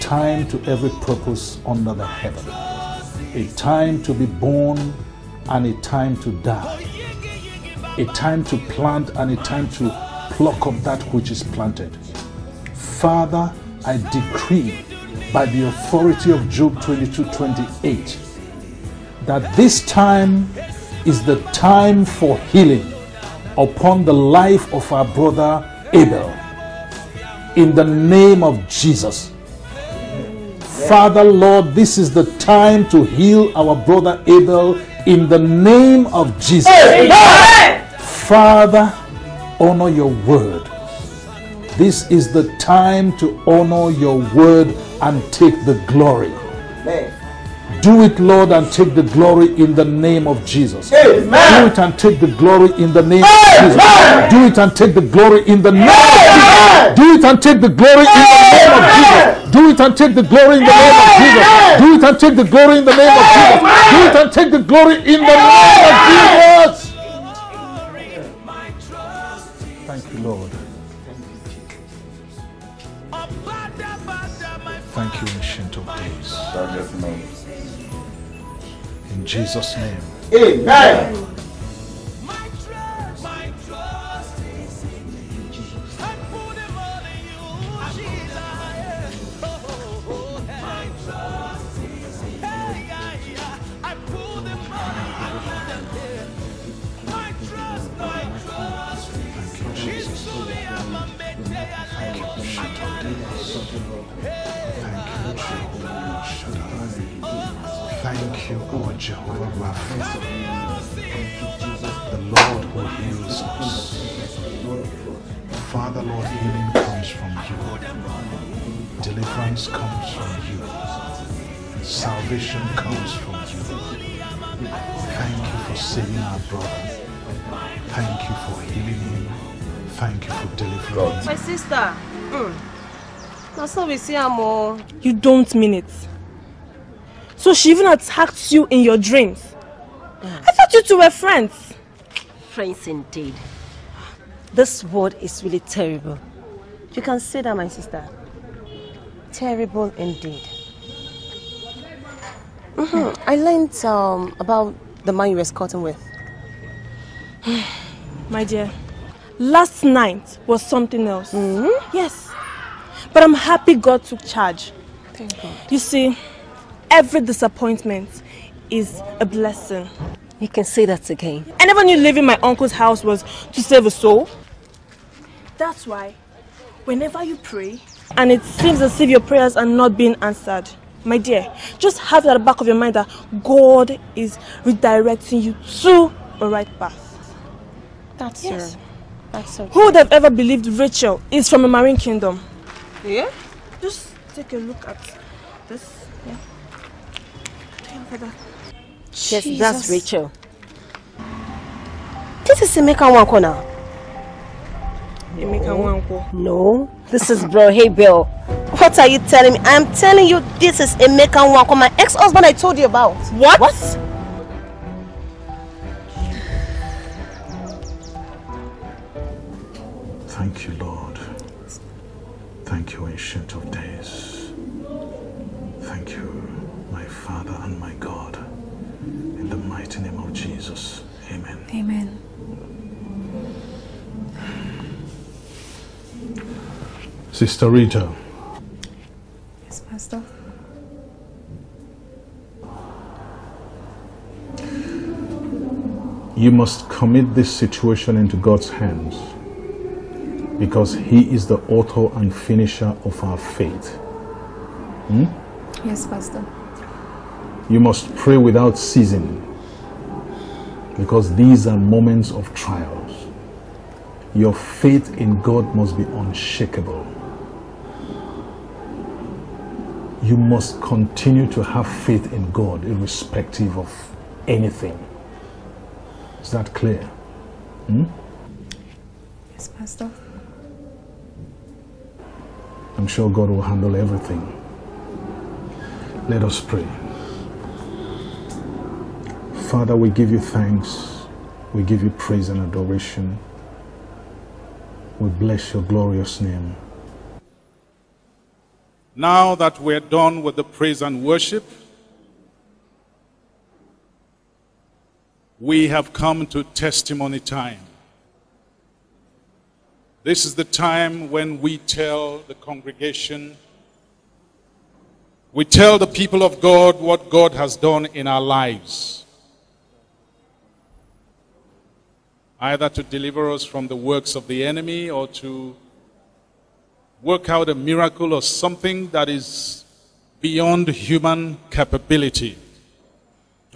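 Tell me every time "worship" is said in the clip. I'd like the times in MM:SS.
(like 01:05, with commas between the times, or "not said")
05:01.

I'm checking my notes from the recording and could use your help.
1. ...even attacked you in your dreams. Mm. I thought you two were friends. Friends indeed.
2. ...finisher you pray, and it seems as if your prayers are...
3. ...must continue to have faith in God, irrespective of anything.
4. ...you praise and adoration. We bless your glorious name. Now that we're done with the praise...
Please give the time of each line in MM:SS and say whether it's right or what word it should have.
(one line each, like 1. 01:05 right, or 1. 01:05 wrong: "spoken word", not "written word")
1. 02:17 right
2. 02:56 wrong: "whenever", not "finisher"
3. 04:30 right
4. 04:52 right.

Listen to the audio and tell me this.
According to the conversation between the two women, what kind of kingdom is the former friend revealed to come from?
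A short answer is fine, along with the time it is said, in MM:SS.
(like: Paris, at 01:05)
marine kingdom, at 03:11.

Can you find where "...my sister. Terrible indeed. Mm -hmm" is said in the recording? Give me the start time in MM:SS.
02:27.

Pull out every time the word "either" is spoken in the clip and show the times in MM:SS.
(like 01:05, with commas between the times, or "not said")
05:22.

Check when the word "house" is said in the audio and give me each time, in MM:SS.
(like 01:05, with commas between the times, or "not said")
02:52.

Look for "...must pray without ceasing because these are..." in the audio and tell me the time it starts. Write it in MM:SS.
04:17.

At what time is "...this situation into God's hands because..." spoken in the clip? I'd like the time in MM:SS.
04:07.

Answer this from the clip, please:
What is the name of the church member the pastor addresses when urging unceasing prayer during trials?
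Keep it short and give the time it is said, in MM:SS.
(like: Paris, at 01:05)
Sister Rita, at 03:57.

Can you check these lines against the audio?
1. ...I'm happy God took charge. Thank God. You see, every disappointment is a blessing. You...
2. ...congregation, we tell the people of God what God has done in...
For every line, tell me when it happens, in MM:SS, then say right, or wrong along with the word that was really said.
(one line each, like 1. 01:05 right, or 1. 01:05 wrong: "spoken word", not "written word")
1. 02:43 right
2. 05:12 right.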